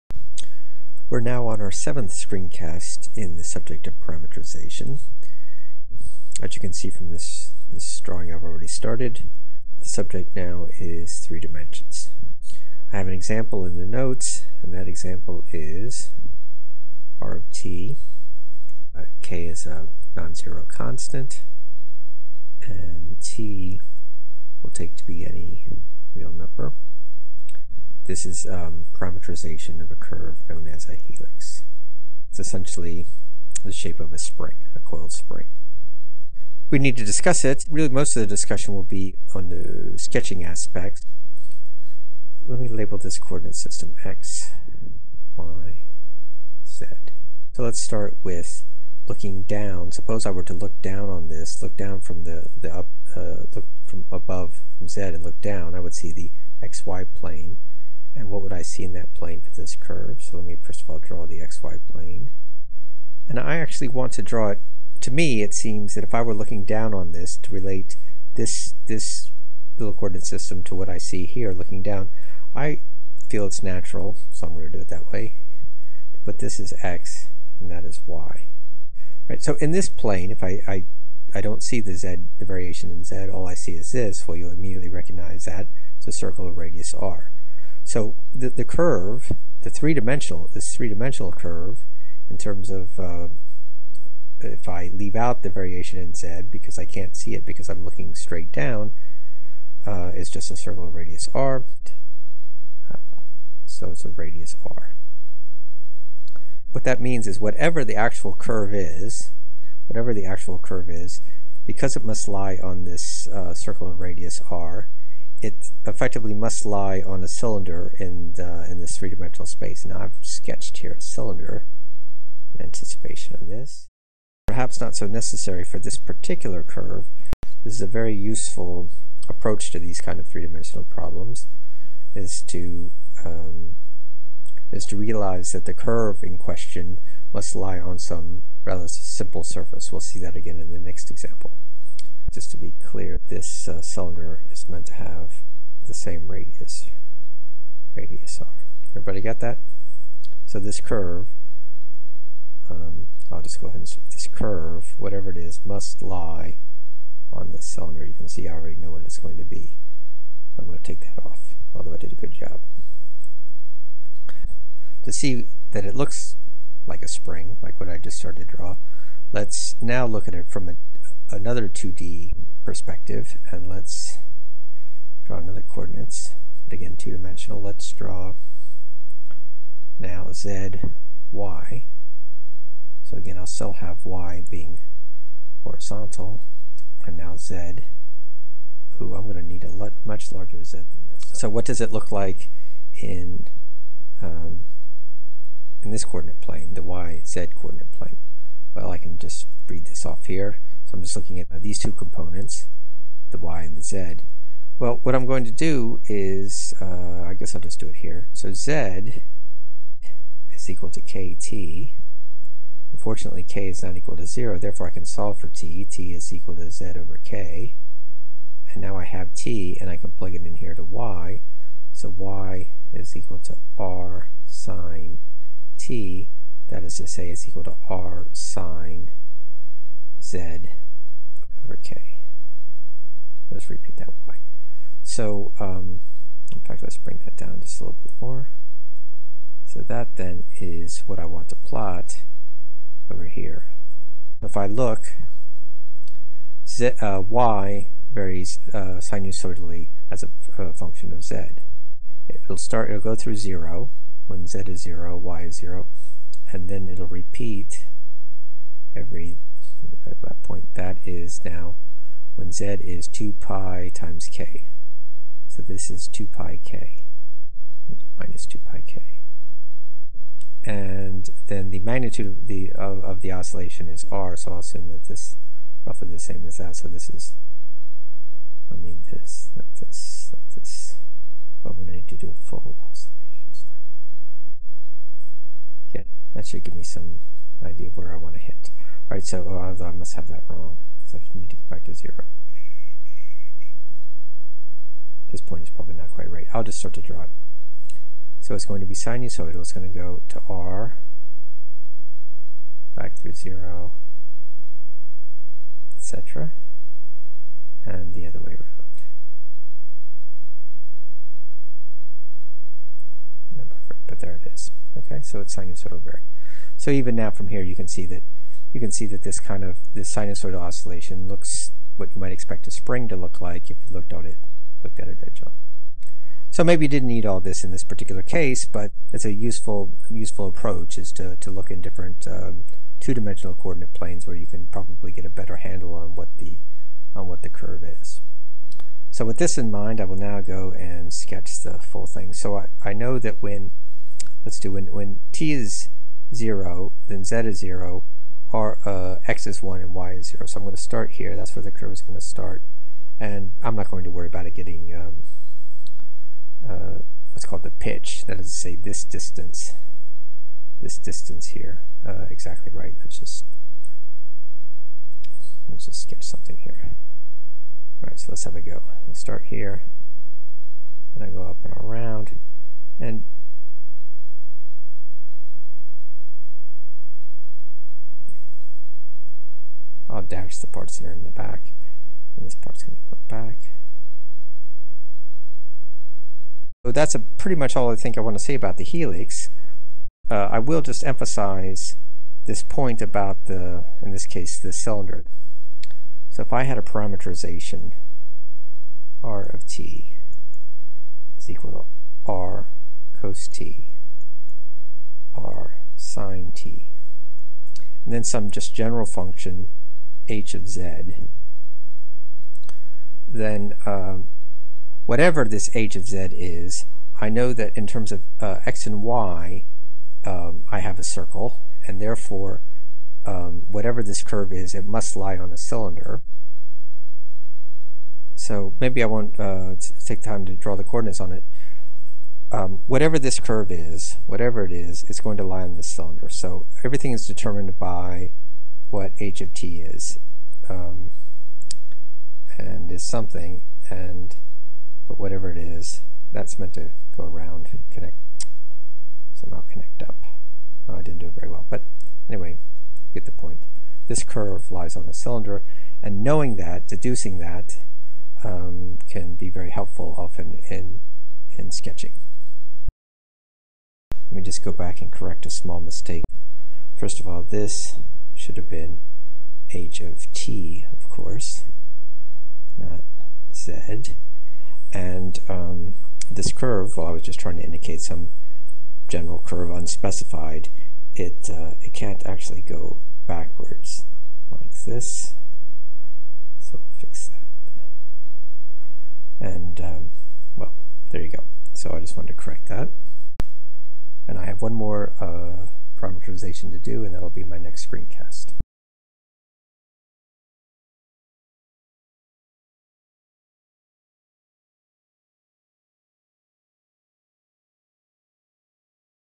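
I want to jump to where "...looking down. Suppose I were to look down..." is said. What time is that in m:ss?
0:49.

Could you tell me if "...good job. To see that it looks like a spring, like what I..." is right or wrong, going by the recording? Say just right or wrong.
right.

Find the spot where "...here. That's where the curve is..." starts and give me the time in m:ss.
5:51.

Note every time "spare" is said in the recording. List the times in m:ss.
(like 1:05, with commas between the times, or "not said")
not said.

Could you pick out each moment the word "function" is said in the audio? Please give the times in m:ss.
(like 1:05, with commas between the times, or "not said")
4:10, 6:49.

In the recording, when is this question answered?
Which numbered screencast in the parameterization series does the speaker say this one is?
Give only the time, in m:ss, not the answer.
0:01.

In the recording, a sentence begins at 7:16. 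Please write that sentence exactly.
So everything is determined by what h of t is.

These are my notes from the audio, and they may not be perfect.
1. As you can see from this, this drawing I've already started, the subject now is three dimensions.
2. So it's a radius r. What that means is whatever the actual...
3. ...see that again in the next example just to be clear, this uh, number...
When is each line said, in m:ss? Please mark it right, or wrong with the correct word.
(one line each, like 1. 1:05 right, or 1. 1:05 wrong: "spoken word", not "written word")
1. 0:06 right
2. 1:43 right
3. 2:20 wrong: "cylinder", not "number".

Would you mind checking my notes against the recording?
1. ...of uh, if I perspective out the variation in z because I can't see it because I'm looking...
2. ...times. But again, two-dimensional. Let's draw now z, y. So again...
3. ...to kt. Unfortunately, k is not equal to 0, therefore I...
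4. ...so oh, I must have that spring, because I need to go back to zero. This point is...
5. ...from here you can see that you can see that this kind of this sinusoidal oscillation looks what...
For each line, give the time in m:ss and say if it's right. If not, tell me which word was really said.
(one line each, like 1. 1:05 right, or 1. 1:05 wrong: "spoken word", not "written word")
1. 1:32 wrong: "leave", not "perspective"
2. 2:55 wrong: "coordinates", not "times"
3. 3:30 right
4. 4:49 wrong: "wrong", not "spring"
5. 5:17 right.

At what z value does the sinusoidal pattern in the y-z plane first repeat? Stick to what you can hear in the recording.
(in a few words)
2 pi k.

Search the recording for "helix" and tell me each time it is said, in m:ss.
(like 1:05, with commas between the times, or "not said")
0:30, 6:28.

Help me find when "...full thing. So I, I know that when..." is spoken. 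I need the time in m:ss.
5:41.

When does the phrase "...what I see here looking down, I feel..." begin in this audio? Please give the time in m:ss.
1:10.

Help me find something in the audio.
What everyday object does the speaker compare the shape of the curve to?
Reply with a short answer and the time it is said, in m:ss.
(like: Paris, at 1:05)
A coiled spring, at 0:34.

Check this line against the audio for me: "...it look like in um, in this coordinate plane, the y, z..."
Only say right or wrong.
right.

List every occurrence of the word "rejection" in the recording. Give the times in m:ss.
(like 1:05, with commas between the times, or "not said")
not said.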